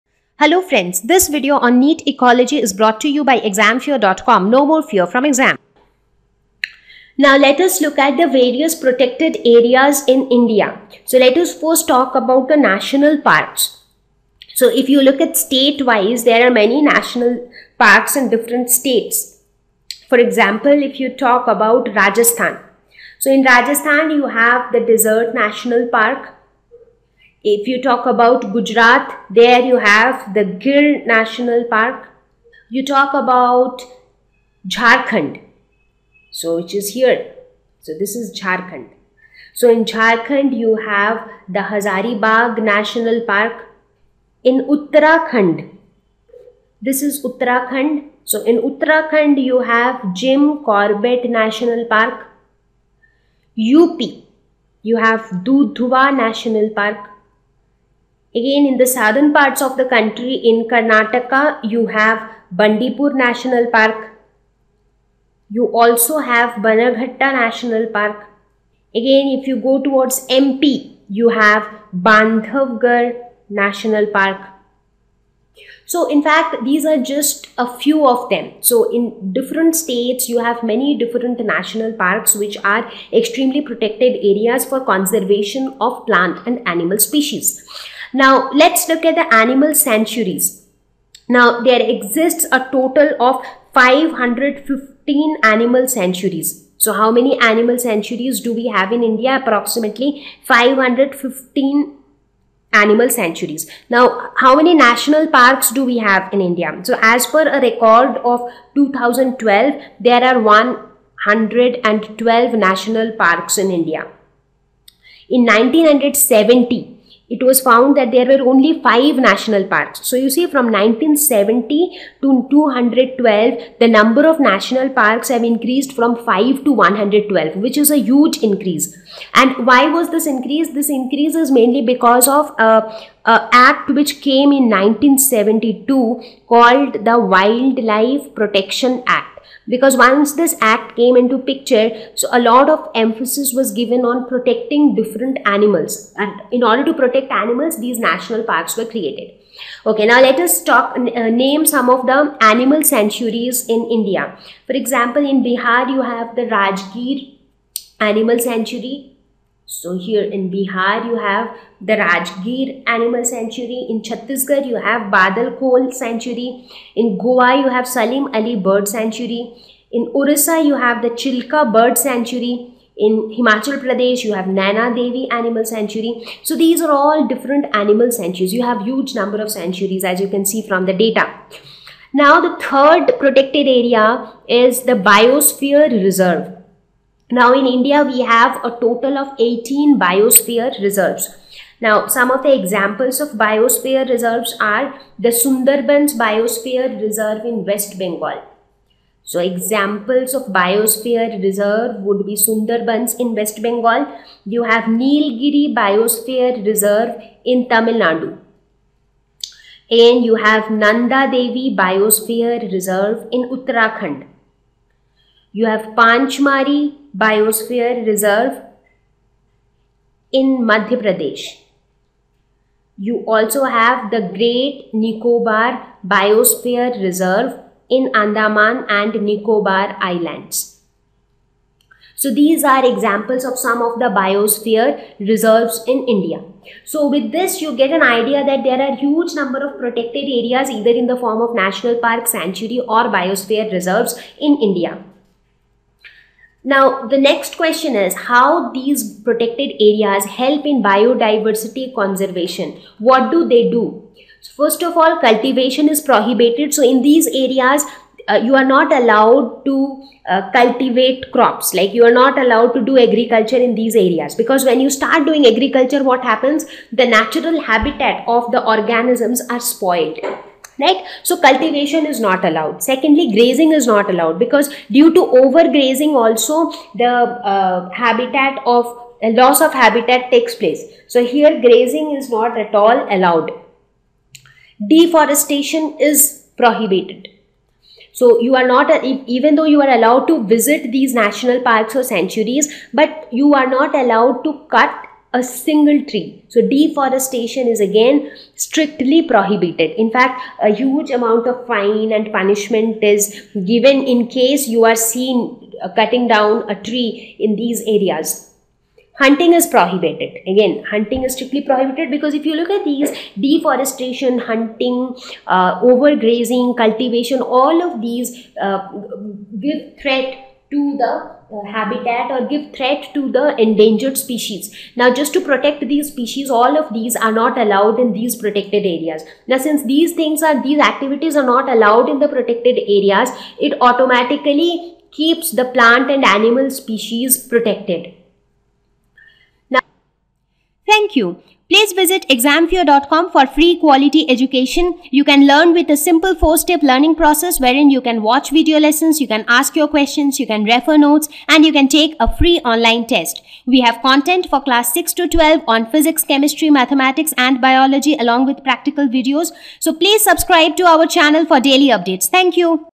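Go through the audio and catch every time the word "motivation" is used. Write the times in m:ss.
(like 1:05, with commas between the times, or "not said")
not said.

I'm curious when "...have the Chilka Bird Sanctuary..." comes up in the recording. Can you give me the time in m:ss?
2:50.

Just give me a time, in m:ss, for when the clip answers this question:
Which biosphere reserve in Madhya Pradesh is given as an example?
3:35.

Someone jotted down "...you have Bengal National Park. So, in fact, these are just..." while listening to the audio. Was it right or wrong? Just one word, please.
wrong.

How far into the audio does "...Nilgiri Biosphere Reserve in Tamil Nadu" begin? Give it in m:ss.
3:24.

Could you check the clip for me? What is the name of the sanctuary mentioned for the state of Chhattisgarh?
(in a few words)
Badal Khol Sanctuary.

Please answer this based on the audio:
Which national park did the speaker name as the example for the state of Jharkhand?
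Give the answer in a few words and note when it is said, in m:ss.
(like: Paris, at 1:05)
Hazaribagh National Park, at 0:41.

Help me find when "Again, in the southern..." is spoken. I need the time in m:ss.
0:58.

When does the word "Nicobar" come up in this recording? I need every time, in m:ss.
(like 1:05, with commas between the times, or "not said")
3:44, 3:49.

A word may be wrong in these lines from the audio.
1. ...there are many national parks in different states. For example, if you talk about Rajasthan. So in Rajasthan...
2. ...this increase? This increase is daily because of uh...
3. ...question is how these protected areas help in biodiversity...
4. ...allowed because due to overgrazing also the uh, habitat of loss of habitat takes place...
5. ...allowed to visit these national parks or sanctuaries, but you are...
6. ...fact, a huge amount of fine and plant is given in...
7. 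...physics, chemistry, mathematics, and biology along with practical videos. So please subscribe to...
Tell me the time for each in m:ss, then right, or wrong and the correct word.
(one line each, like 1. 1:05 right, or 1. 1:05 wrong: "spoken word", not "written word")
1. 0:16 right
2. 2:10 wrong: "mainly", not "daily"
3. 4:07 right
4. 4:34 right
5. 4:49 right
6. 5:00 wrong: "punishment", not "plant"
7. 5:55 right.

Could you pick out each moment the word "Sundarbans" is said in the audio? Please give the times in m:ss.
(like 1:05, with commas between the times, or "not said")
3:15, 3:22.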